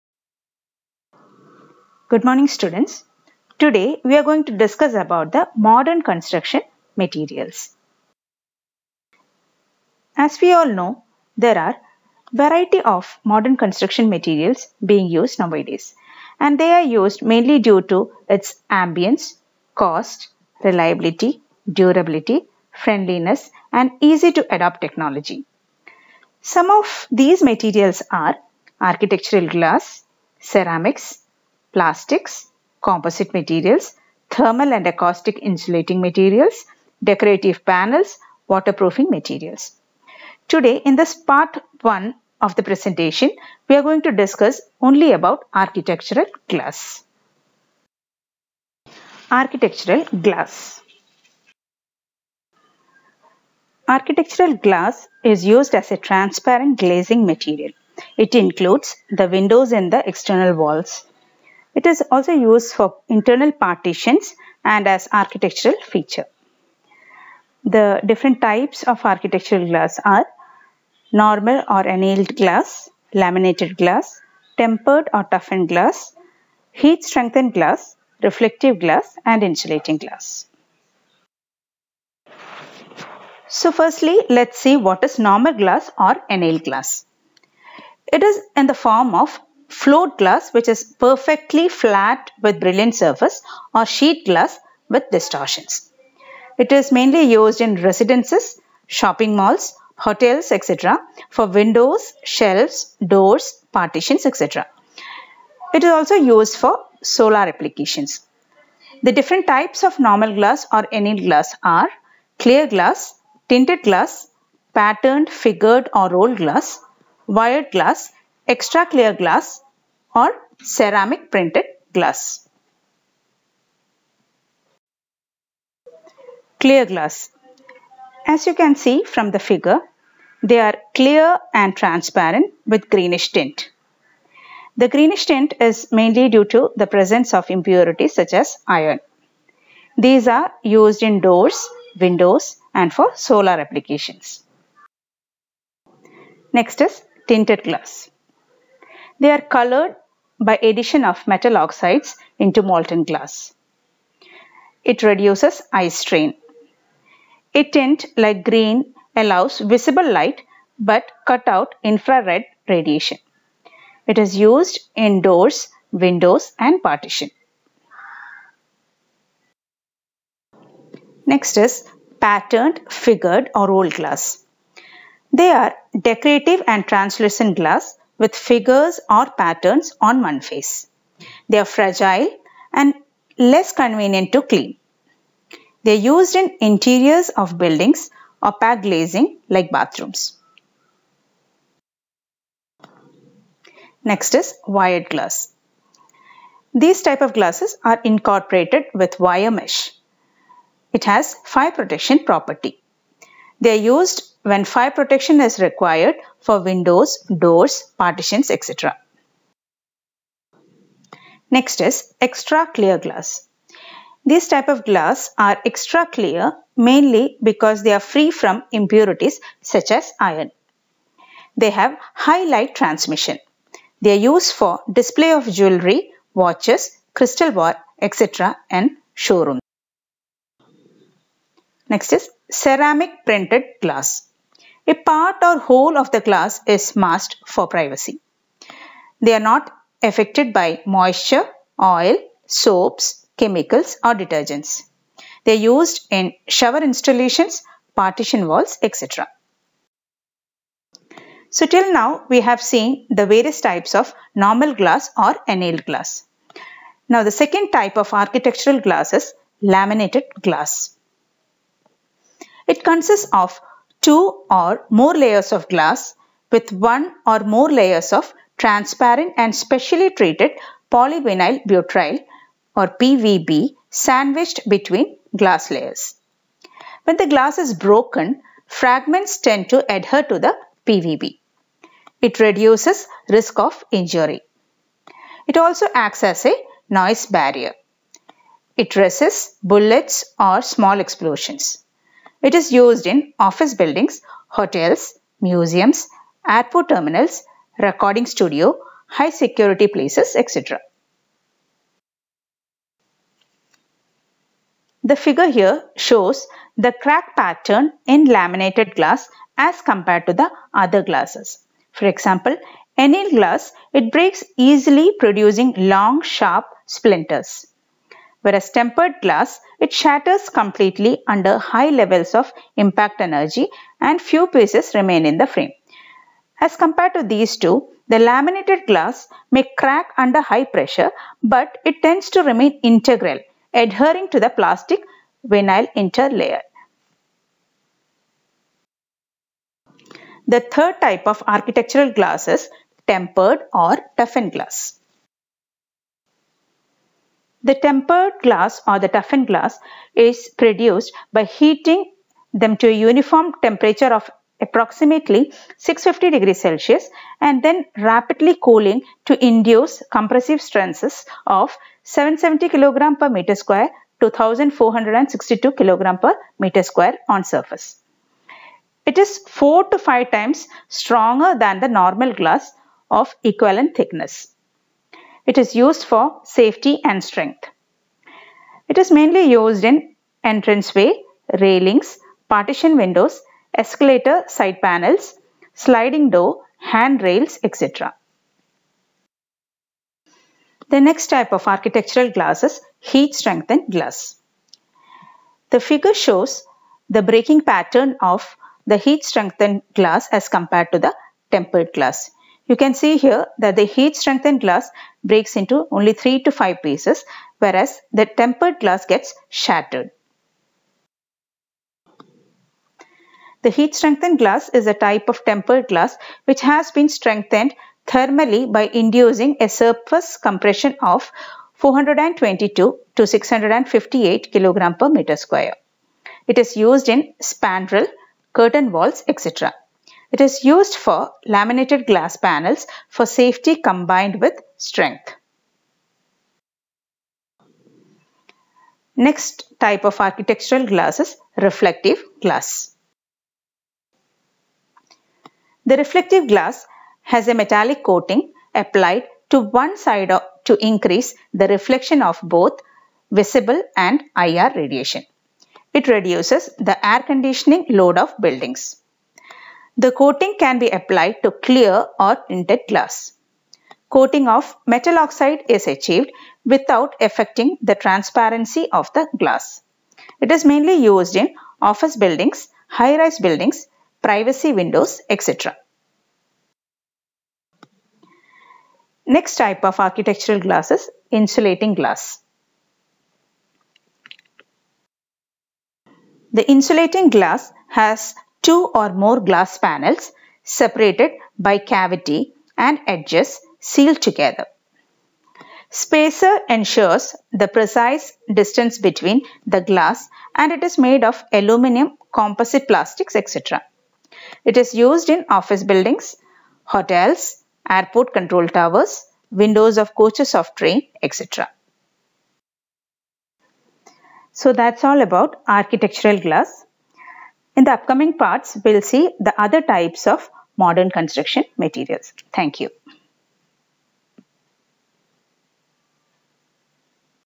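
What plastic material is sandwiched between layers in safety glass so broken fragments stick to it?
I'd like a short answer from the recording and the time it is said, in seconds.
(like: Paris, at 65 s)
polyvinyl butyl, at 270 s.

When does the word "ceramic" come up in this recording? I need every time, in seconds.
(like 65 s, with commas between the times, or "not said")
30 s, 120 s, 232 s.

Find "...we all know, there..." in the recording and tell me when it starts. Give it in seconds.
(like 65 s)
10 s.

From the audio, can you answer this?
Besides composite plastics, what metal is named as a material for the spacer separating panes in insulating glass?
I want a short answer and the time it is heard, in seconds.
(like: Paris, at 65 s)
aluminum, at 501 s.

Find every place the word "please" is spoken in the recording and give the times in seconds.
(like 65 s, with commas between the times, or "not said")
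not said.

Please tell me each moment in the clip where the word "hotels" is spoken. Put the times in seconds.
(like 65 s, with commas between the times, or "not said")
99 s, 294 s, 506 s.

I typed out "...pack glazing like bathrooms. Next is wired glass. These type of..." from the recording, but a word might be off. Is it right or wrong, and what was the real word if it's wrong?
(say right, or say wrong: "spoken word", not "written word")
right.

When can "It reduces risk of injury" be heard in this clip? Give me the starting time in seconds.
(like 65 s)
282 s.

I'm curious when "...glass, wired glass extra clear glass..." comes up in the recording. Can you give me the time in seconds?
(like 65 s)
116 s.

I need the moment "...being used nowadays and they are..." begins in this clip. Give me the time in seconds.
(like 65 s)
14 s.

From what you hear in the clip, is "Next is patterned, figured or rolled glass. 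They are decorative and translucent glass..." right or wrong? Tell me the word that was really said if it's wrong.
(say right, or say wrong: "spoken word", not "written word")
right.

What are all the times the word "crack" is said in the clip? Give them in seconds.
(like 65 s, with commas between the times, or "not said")
307 s, 329 s.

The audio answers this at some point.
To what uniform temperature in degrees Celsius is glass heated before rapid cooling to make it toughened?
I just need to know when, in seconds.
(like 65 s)
355 s.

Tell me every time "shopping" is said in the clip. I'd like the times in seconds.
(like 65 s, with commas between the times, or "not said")
98 s.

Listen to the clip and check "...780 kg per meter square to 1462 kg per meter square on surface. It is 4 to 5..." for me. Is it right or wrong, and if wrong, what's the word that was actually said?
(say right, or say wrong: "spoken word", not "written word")
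wrong: "770", not "780".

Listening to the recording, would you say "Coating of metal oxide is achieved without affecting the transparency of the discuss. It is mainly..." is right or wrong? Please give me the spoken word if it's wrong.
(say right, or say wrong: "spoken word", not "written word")
wrong: "glass", not "discuss".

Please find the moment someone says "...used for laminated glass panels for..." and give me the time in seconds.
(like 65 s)
430 s.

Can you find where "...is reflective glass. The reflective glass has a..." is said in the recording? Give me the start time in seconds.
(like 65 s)
441 s.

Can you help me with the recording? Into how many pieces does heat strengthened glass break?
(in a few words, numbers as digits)
3 to 5 pieces.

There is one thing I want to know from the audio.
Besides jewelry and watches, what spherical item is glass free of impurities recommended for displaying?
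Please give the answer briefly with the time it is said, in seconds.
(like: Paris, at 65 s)
crystal ball, at 227 s.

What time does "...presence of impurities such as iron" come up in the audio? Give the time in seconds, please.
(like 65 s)
136 s.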